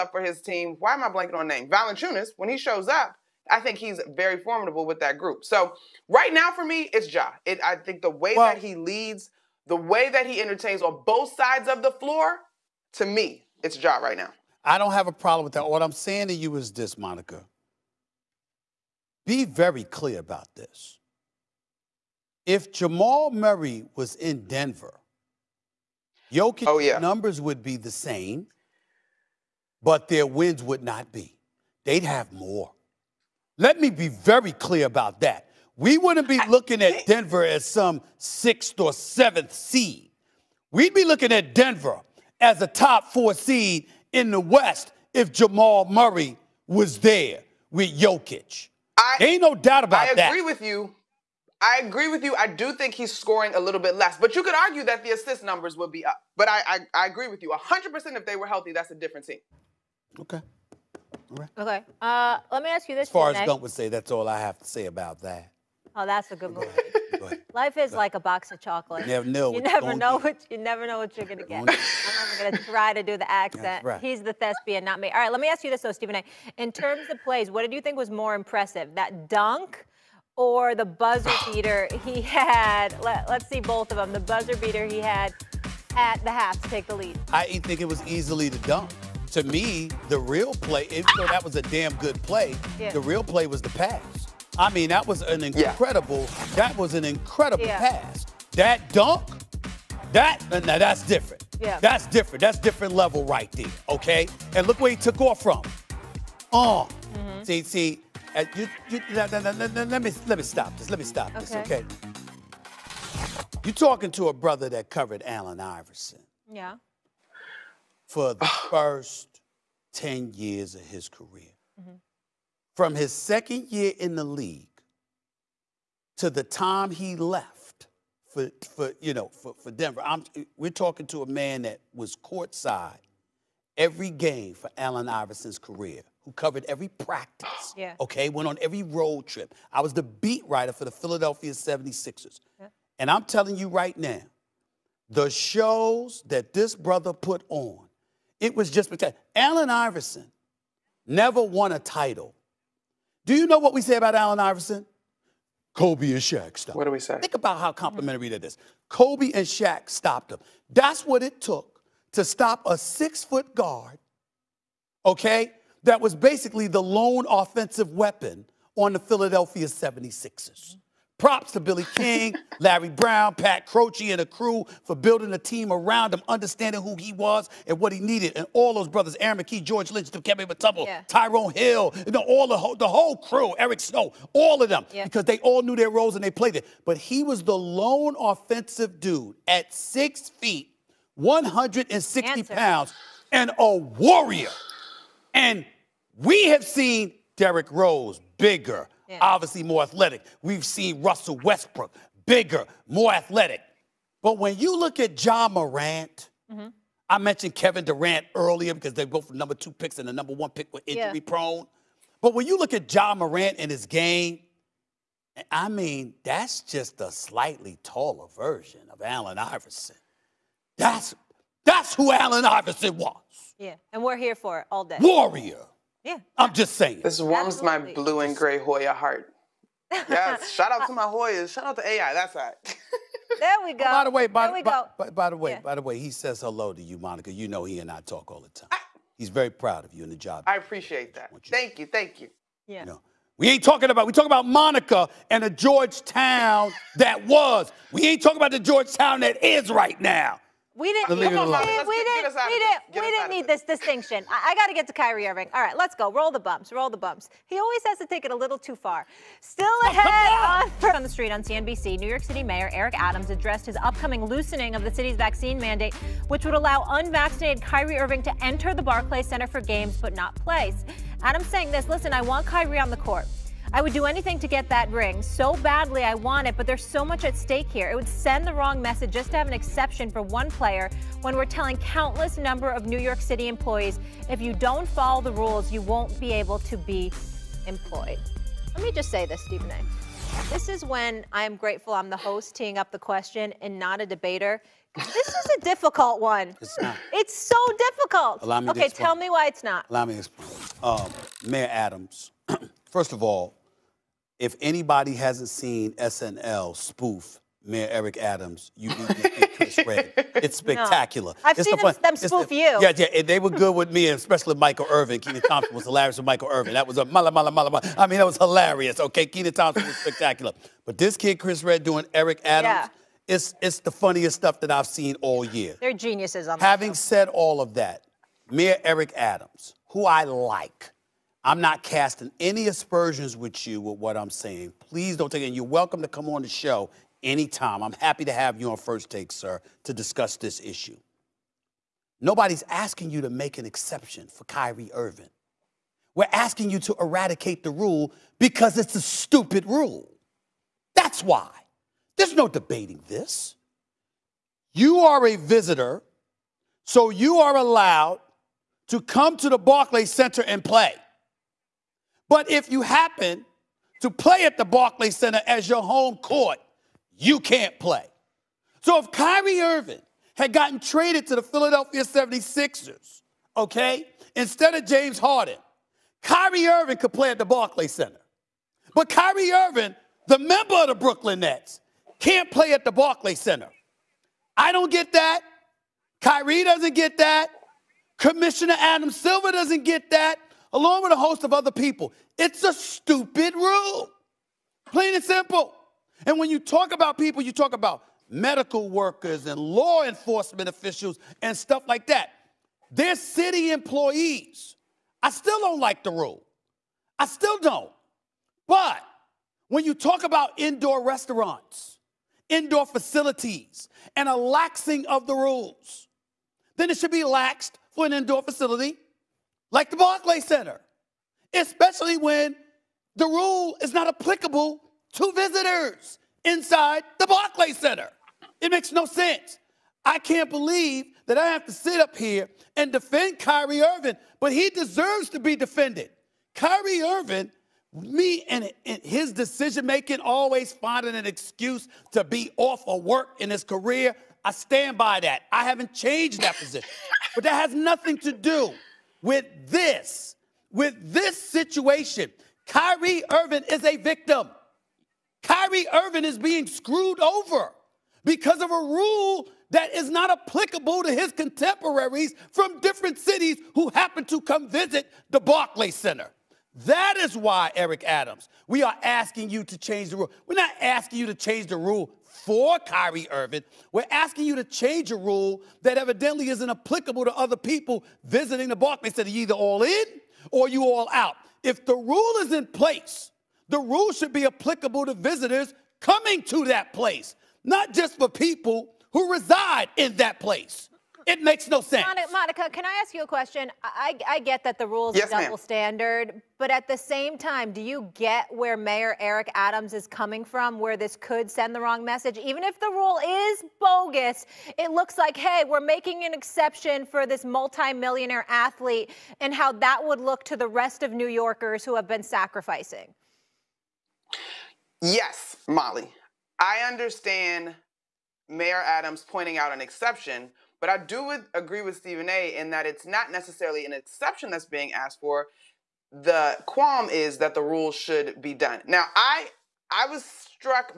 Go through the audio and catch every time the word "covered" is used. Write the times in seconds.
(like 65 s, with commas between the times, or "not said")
114 s, 136 s.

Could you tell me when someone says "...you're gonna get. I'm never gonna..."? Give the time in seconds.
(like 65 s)
71 s.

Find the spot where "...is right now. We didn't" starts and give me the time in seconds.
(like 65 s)
249 s.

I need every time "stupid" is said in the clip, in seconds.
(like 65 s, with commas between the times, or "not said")
349 s, 392 s.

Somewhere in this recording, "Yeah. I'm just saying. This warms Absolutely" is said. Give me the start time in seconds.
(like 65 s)
226 s.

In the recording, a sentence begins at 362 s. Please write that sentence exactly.
But if you happen to play at the Barclays Center as your home court, you can't play.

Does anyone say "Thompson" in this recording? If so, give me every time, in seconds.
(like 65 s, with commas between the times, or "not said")
315 s, 319 s.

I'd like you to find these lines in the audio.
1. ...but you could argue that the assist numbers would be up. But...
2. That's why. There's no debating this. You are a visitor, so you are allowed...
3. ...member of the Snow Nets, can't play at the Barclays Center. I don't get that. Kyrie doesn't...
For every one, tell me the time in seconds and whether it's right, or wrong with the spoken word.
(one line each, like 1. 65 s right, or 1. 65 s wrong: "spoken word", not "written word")
1. 54 s right
2. 350 s right
3. 380 s wrong: "Brooklyn", not "Snow".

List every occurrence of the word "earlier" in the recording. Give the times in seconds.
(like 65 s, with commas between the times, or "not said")
208 s.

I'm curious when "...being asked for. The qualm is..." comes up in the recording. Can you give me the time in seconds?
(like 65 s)
524 s.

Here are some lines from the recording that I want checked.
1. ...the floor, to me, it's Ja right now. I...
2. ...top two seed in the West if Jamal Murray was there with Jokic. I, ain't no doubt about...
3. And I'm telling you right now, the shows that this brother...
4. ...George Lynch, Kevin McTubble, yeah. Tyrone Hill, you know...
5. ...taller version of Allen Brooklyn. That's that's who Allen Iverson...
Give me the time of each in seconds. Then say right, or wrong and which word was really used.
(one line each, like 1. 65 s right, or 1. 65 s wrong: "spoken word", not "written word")
1. 11 s right
2. 42 s wrong: "four", not "two"
3. 142 s right
4. 179 s right
5. 217 s wrong: "Iverson", not "Brooklyn".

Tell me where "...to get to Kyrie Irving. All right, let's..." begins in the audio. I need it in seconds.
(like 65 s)
254 s.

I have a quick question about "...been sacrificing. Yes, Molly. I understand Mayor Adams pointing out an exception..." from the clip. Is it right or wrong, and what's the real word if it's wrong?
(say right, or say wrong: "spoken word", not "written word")
right.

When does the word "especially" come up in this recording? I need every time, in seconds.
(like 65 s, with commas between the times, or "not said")
314 s, 421 s.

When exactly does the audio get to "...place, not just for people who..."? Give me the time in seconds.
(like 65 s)
486 s.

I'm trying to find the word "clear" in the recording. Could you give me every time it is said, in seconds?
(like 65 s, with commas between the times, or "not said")
19 s, 34 s.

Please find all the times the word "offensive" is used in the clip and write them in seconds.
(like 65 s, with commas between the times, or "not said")
167 s, 188 s.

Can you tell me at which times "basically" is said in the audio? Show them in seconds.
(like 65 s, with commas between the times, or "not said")
166 s.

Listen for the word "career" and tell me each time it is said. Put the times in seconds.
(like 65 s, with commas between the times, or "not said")
121 s, 135 s, 443 s.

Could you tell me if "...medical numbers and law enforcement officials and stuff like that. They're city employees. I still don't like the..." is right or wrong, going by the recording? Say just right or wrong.
wrong.